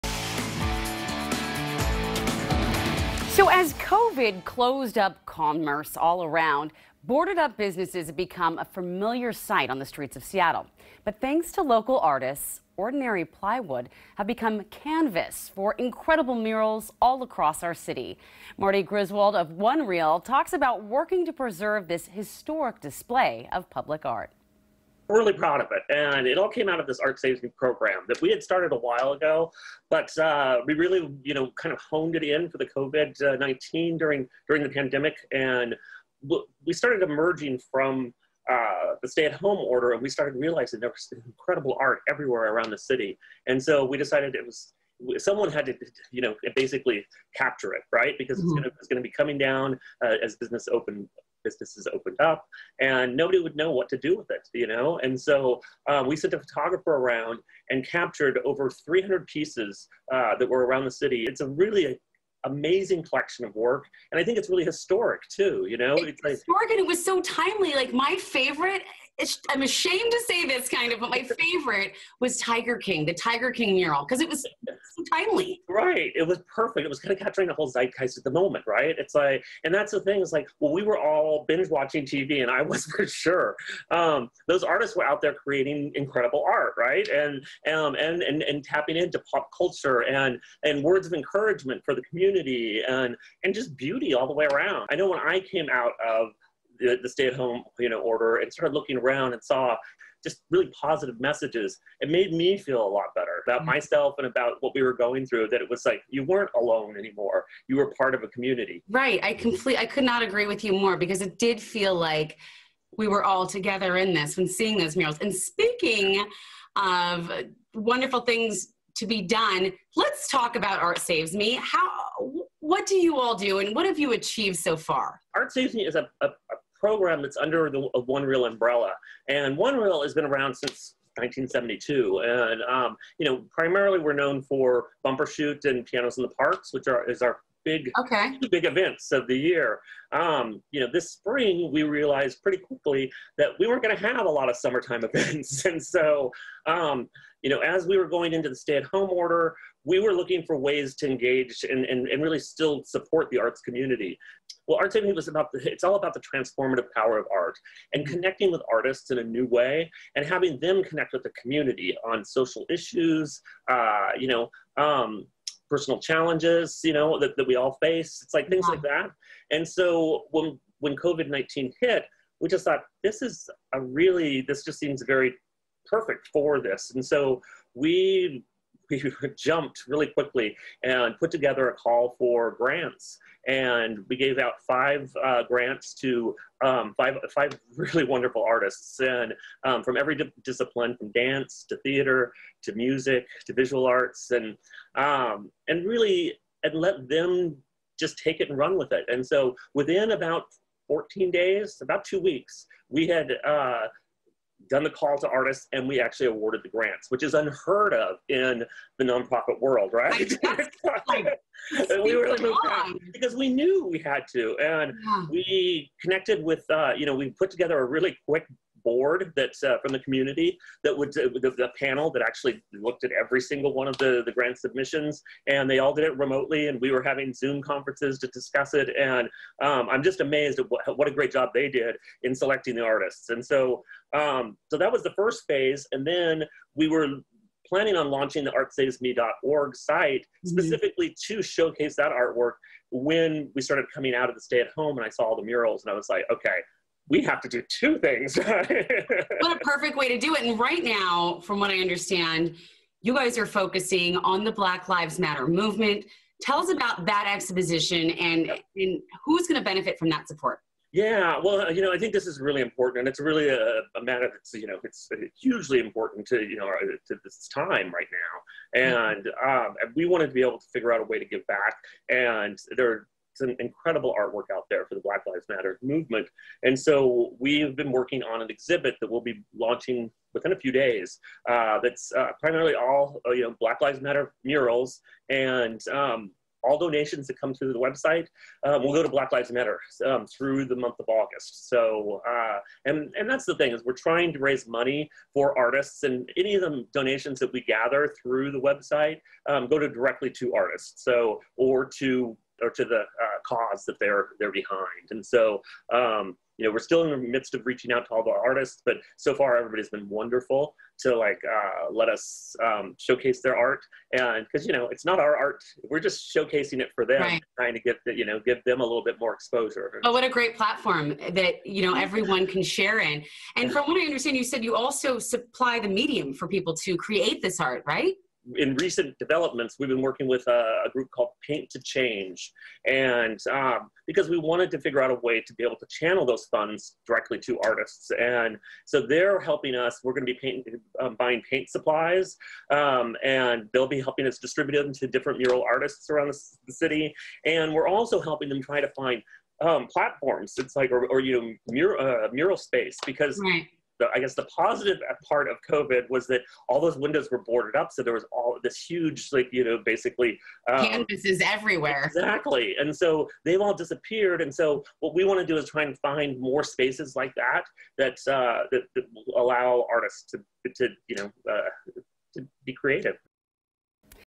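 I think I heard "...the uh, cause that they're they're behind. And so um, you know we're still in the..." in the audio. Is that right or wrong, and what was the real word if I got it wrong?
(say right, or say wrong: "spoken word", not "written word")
right.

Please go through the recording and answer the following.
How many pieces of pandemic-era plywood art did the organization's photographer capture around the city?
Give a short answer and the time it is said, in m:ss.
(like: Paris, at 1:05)
over 300, at 0:58.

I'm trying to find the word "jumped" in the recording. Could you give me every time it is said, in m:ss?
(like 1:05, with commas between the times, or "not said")
2:59.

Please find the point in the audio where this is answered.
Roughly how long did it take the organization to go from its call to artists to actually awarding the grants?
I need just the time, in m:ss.
3:20.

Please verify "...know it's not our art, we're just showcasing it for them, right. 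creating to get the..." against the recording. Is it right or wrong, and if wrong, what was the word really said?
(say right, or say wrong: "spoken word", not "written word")
wrong: "trying", not "creating".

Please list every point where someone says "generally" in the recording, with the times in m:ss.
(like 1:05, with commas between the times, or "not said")
not said.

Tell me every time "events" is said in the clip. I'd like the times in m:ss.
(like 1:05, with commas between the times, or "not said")
2:18, 2:25.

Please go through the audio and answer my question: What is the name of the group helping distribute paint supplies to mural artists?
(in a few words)
Paint to Change.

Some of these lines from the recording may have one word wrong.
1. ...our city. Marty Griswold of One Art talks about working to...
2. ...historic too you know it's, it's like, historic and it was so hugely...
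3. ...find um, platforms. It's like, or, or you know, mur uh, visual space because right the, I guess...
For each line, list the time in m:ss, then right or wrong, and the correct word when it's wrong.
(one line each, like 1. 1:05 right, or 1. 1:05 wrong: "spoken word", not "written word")
1. 0:17 wrong: "Reel", not "Art"
2. 1:04 wrong: "timely", not "hugely"
3. 5:48 wrong: "mural", not "visual".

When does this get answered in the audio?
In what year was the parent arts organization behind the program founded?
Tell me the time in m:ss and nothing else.
2:11.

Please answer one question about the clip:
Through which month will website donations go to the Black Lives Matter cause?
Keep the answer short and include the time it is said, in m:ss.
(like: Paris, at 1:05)
August, at 4:51.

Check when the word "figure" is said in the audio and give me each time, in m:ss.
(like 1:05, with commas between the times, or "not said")
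4:30, 5:34.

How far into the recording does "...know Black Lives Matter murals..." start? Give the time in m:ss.
4:43.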